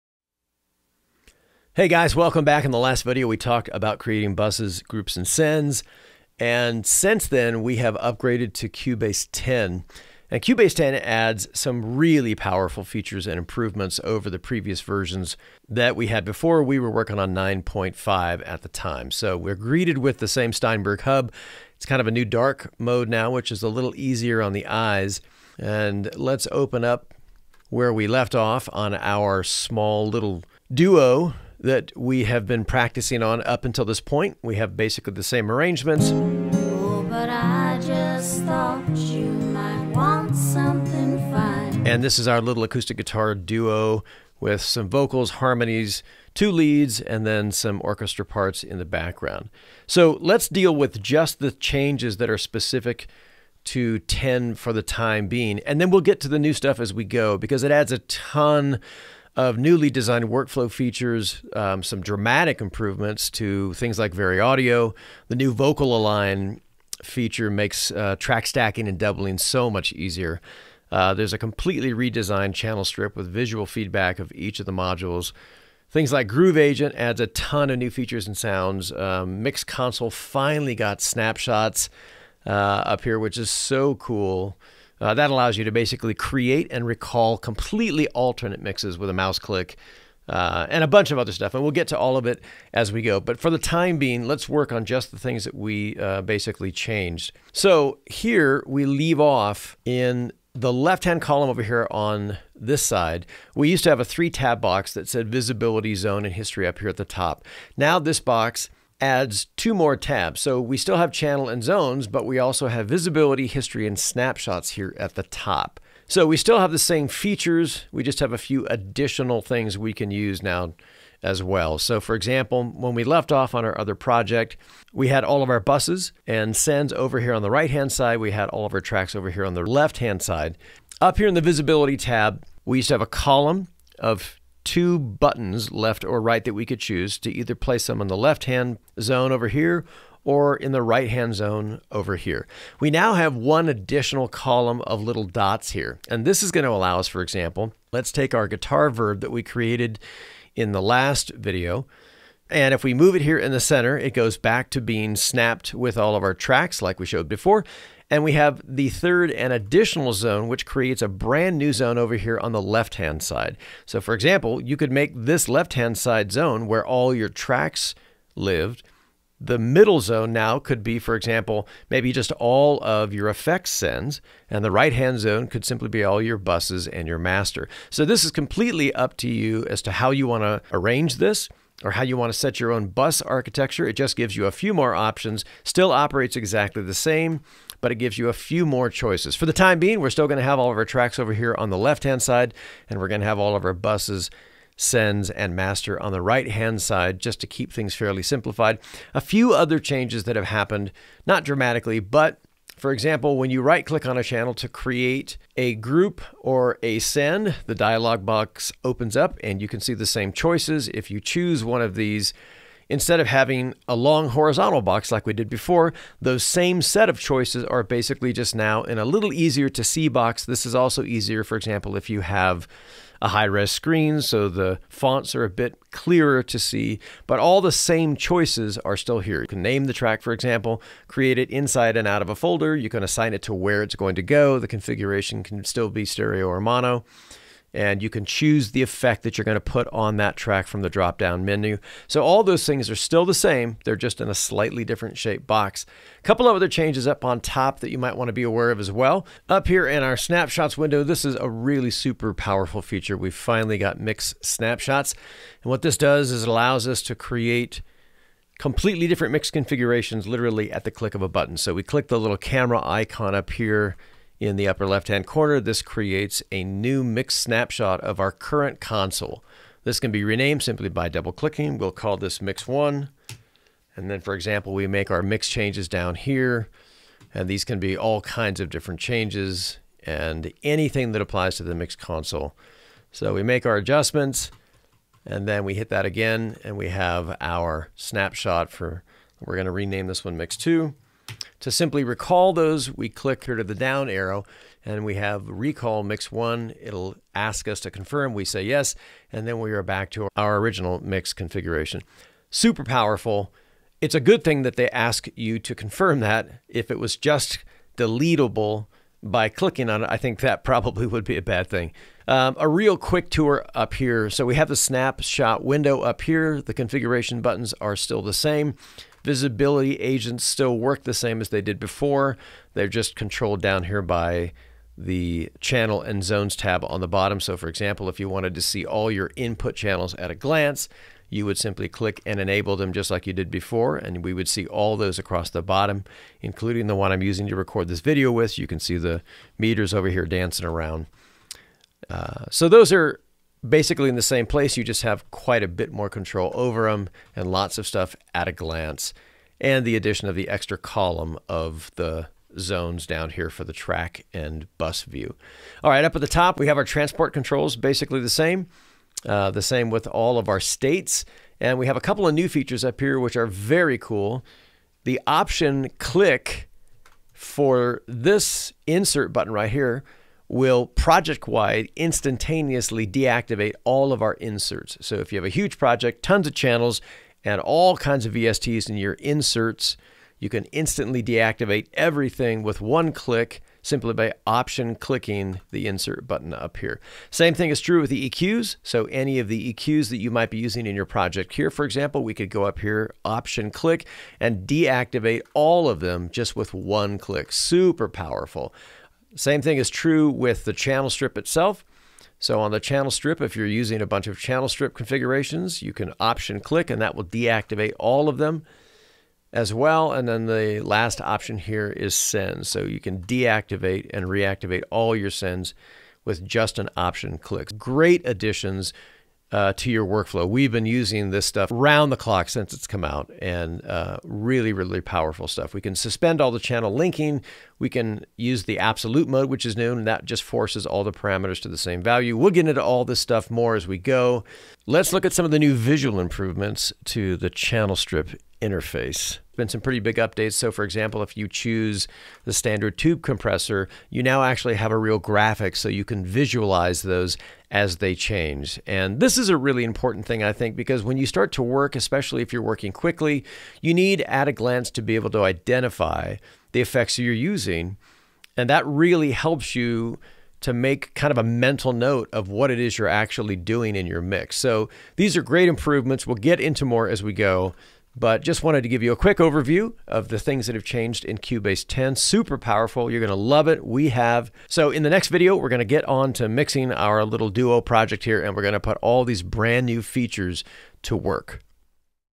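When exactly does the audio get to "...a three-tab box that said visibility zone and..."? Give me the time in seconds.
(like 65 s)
104 s.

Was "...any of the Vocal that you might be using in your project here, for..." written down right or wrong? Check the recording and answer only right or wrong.
wrong.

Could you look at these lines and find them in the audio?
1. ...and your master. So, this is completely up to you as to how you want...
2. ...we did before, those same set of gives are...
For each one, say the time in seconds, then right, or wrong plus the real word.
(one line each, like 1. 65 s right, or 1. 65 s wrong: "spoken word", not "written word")
1. 176 s right
2. 215 s wrong: "choices", not "gives".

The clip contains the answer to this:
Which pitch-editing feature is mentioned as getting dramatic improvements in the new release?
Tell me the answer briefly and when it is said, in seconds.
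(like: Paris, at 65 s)
VariAudio, at 64 s.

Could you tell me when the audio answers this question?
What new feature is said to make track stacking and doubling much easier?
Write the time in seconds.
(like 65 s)
65 s.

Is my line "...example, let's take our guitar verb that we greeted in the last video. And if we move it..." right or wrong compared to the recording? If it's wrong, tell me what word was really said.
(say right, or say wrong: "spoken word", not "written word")
wrong: "created", not "greeted".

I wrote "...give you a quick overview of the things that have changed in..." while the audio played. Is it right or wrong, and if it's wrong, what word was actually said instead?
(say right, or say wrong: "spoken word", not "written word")
right.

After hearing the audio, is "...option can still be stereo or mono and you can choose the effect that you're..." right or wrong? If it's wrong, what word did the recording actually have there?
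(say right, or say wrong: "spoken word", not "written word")
wrong: "configuration", not "option".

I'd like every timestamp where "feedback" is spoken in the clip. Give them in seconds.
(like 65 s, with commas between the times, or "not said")
73 s.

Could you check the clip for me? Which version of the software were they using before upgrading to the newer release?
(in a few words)
9.5.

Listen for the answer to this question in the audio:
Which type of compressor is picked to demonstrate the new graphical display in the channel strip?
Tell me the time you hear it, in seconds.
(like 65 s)
442 s.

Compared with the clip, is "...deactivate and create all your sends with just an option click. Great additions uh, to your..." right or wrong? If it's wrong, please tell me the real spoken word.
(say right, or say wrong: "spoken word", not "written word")
wrong: "reactivate", not "create".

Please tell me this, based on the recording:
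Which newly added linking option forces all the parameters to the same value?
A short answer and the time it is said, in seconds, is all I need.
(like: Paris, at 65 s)
absolute mode, at 428 s.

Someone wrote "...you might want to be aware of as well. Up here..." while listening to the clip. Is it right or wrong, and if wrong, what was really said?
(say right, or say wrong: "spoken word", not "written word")
right.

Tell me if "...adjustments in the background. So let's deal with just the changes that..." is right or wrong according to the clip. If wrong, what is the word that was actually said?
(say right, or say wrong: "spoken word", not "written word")
wrong: "parts", not "adjustments".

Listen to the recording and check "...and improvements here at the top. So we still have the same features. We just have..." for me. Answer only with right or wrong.
wrong.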